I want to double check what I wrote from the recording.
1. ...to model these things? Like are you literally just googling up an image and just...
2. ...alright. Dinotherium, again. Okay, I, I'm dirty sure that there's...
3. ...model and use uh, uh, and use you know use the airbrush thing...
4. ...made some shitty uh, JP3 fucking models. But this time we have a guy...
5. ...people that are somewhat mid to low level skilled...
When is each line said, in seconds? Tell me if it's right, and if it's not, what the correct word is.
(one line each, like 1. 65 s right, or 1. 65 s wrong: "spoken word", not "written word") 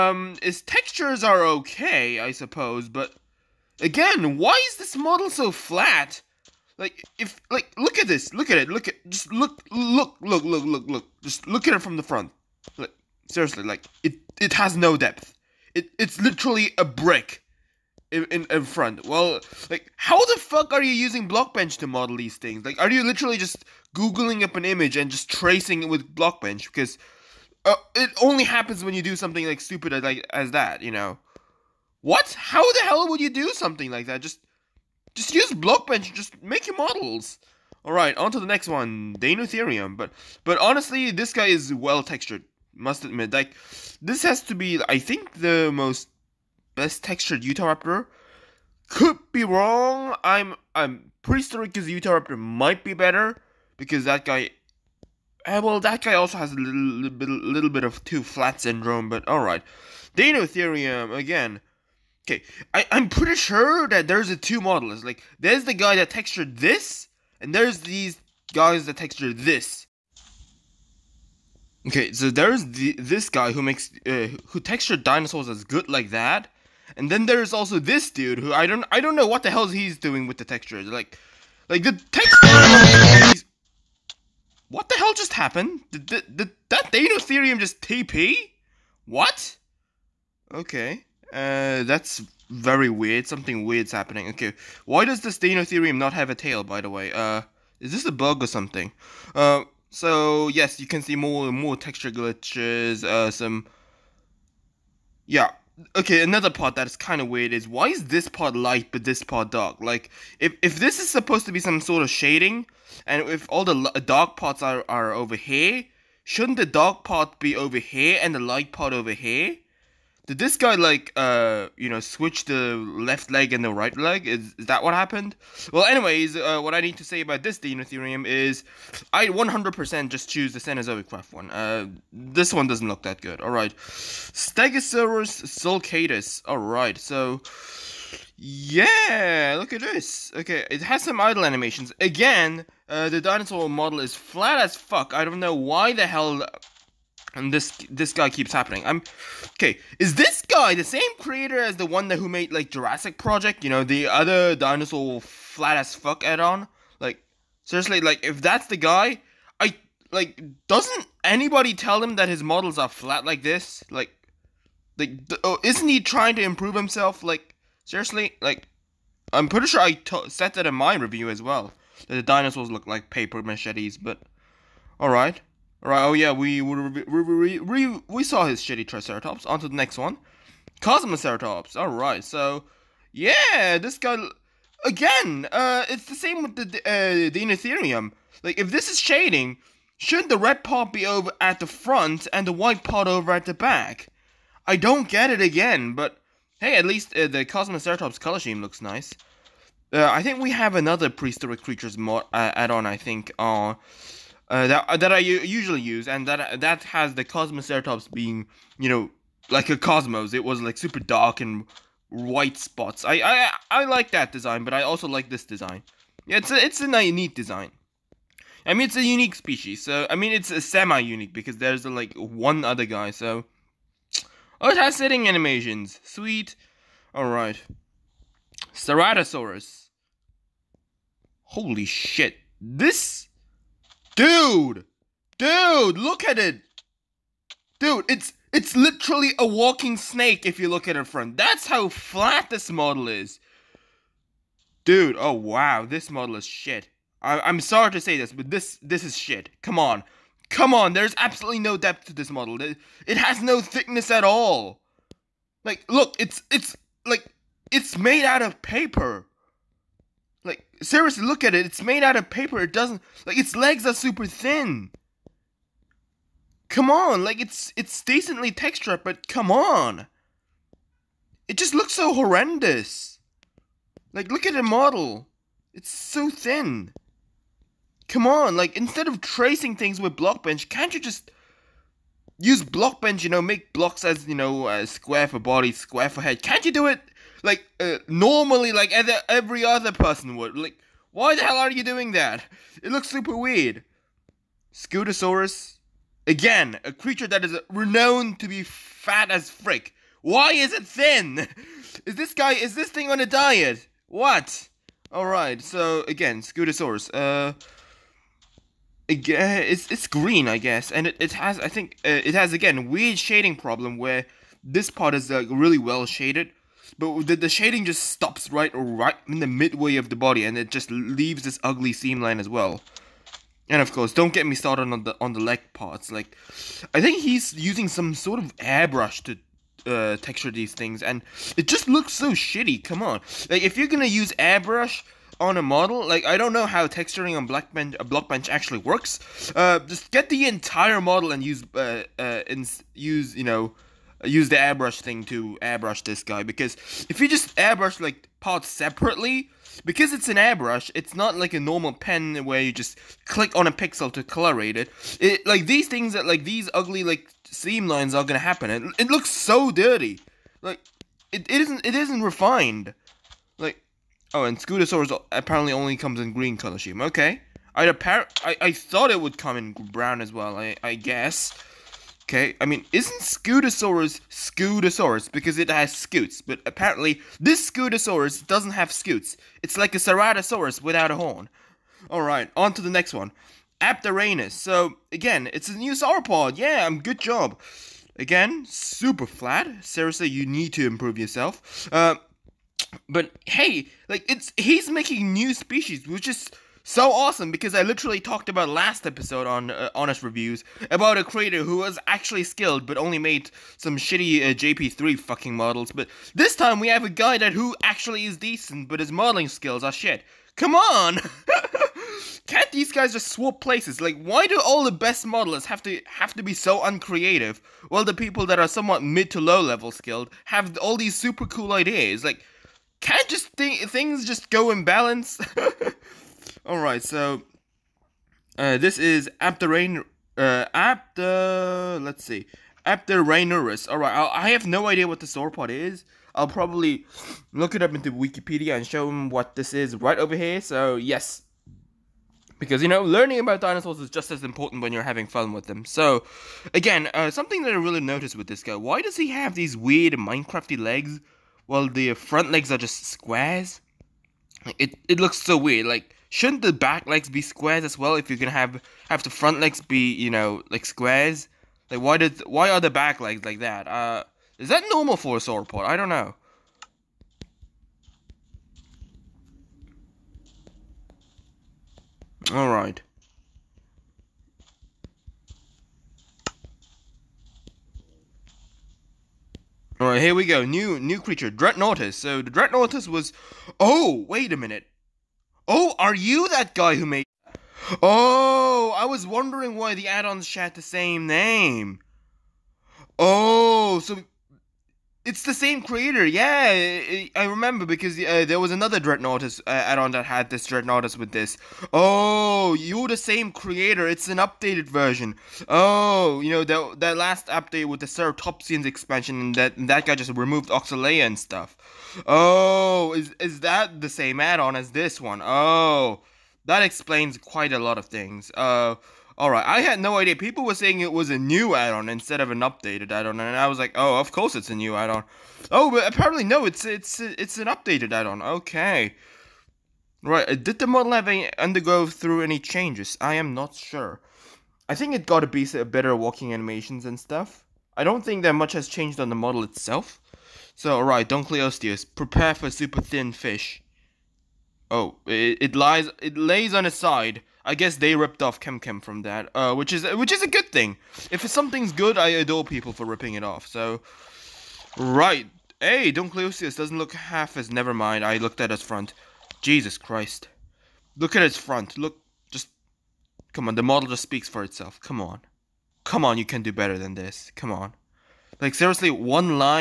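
1. 21 s right
2. 59 s wrong: "pretty", not "dirty"
3. 341 s right
4. 403 s right
5. 418 s right.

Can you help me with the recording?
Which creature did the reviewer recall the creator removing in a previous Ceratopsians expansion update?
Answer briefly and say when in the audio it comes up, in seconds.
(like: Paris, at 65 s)
Oxalaia, at 510 s.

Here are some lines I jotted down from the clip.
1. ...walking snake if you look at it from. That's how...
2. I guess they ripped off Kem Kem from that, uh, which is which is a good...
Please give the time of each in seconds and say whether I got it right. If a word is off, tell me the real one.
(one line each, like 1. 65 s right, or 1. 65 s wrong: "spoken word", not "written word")
1. 239 s right
2. 547 s right.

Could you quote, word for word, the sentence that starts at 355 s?
It like these things that like these ugly like seam lines are gonna happen.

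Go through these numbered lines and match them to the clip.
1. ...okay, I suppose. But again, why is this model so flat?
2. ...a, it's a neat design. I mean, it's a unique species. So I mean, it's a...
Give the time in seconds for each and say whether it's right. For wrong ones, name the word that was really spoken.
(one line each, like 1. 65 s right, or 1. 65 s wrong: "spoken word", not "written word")
1. 1 s right
2. 216 s right.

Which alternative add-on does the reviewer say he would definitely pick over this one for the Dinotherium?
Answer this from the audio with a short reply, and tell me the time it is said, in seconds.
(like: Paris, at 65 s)
Cenozoic Craft, at 130 s.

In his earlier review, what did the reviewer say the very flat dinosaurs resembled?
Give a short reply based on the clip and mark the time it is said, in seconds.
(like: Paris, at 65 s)
paper machetes, at 173 s.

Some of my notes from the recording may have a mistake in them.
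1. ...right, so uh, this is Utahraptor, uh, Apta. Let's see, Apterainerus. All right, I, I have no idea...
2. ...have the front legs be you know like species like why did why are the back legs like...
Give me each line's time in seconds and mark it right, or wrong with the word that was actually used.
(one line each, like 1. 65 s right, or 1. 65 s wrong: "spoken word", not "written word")
1. 426 s wrong: "Apterain", not "Utahraptor"
2. 459 s wrong: "squares", not "species".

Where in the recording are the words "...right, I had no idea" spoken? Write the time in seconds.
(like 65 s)
519 s.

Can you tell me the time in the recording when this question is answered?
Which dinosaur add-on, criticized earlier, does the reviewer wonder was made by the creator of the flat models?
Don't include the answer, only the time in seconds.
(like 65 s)
152 s.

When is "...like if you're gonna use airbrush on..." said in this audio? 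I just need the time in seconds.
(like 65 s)
333 s.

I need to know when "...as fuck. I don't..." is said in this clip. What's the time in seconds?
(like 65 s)
144 s.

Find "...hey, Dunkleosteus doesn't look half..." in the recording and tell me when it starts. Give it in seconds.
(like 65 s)
555 s.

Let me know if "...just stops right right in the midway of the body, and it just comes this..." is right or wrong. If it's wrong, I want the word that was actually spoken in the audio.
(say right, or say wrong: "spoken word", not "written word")
wrong: "leaves", not "comes".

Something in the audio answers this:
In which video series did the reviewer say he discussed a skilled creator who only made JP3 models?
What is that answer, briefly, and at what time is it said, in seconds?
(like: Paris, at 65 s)
Honest Reviews, at 399 s.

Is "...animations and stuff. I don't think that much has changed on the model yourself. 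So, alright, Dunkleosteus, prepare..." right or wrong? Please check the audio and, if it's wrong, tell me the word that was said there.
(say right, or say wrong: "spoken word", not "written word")
wrong: "itself", not "yourself".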